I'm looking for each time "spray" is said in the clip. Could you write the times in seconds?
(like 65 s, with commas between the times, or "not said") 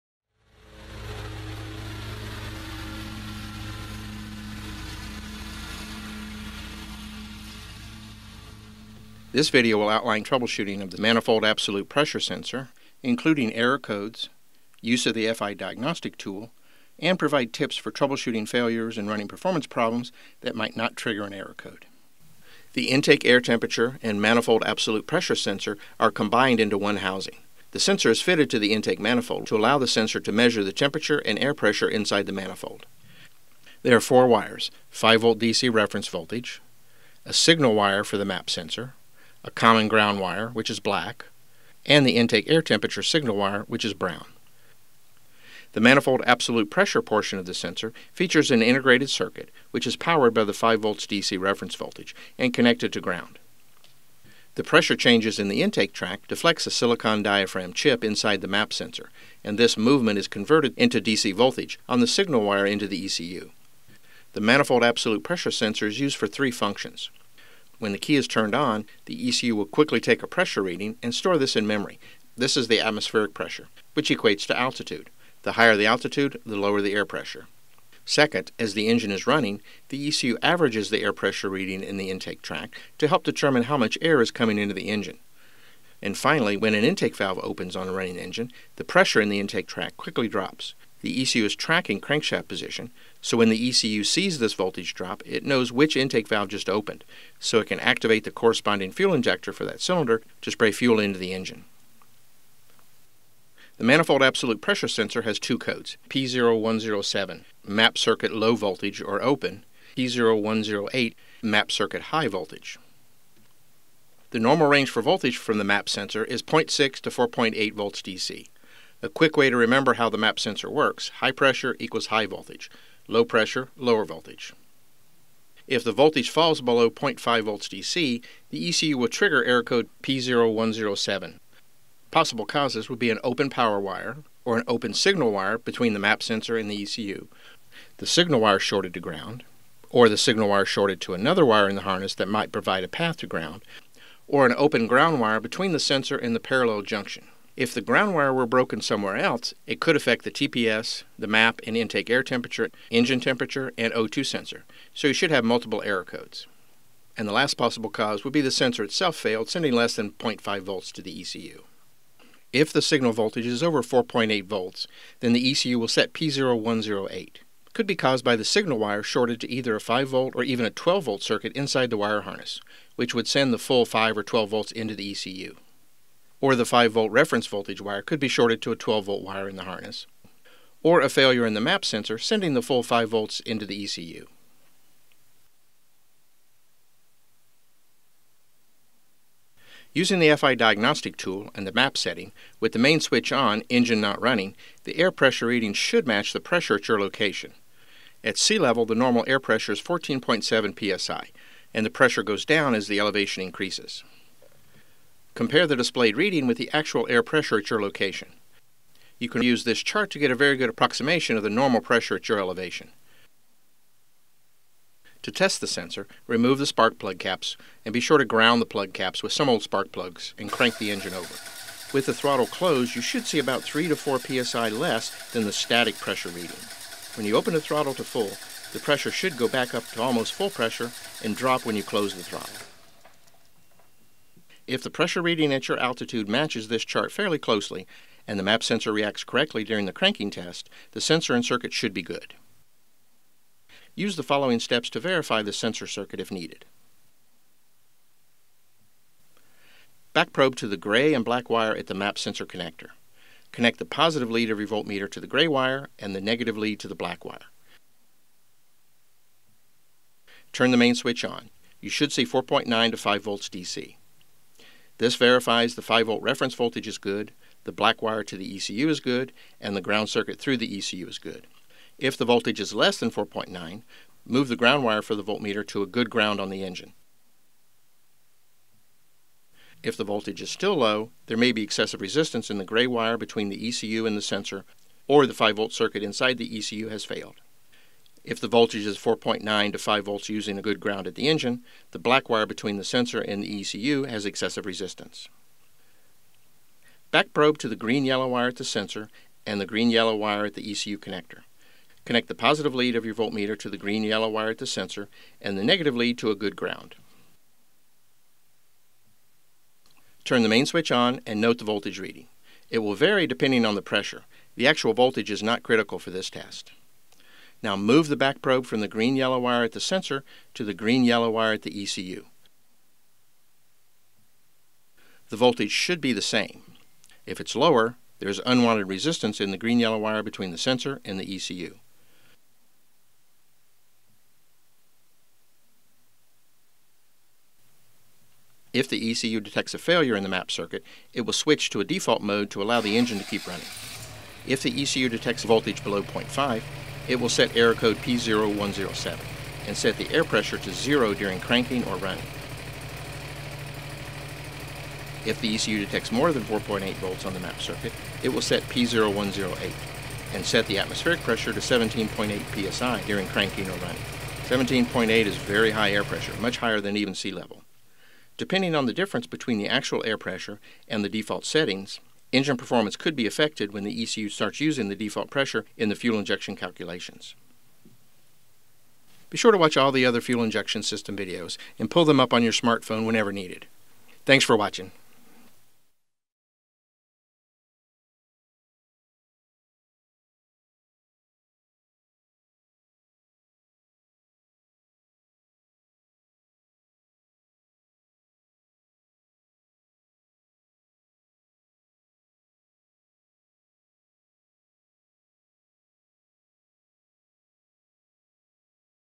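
100 s.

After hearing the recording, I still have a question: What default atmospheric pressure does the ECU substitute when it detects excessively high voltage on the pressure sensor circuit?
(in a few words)
17.8 psi.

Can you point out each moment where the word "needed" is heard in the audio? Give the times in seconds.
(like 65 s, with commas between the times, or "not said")
246 s, 383 s.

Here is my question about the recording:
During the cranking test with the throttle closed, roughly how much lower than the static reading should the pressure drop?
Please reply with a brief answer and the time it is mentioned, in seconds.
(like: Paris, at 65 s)
3 to 4 psi, at 223 s.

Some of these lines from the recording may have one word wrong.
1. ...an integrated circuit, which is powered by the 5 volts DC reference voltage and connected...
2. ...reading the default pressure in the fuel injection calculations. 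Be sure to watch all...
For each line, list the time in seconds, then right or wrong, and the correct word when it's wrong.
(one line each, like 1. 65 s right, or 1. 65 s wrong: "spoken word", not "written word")
1. 48 s right
2. 374 s wrong: "using", not "reading".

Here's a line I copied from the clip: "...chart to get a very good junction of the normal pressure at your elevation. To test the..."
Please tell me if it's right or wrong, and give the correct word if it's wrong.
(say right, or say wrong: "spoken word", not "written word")
wrong: "approximation", not "junction".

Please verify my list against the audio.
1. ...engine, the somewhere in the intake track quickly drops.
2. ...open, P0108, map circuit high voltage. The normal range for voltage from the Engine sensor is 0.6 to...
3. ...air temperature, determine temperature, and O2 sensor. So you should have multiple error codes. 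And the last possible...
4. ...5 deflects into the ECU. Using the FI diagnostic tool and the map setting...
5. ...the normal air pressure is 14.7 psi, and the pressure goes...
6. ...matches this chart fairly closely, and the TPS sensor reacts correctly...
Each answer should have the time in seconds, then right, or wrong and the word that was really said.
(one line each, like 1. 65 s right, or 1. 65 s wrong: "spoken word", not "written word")
1. 88 s wrong: "pressure", not "somewhere"
2. 109 s wrong: "MAP", not "Engine"
3. 152 s wrong: "engine", not "determine"
4. 182 s wrong: "volts", not "deflects"
5. 198 s right
6. 236 s wrong: "MAP", not "TPS".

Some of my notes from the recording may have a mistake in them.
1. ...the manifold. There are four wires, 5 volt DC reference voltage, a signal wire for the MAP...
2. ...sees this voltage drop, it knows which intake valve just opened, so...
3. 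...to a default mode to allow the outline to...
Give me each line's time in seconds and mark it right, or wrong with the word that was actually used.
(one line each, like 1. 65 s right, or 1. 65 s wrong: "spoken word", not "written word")
1. 32 s right
2. 94 s right
3. 341 s wrong: "engine", not "outline".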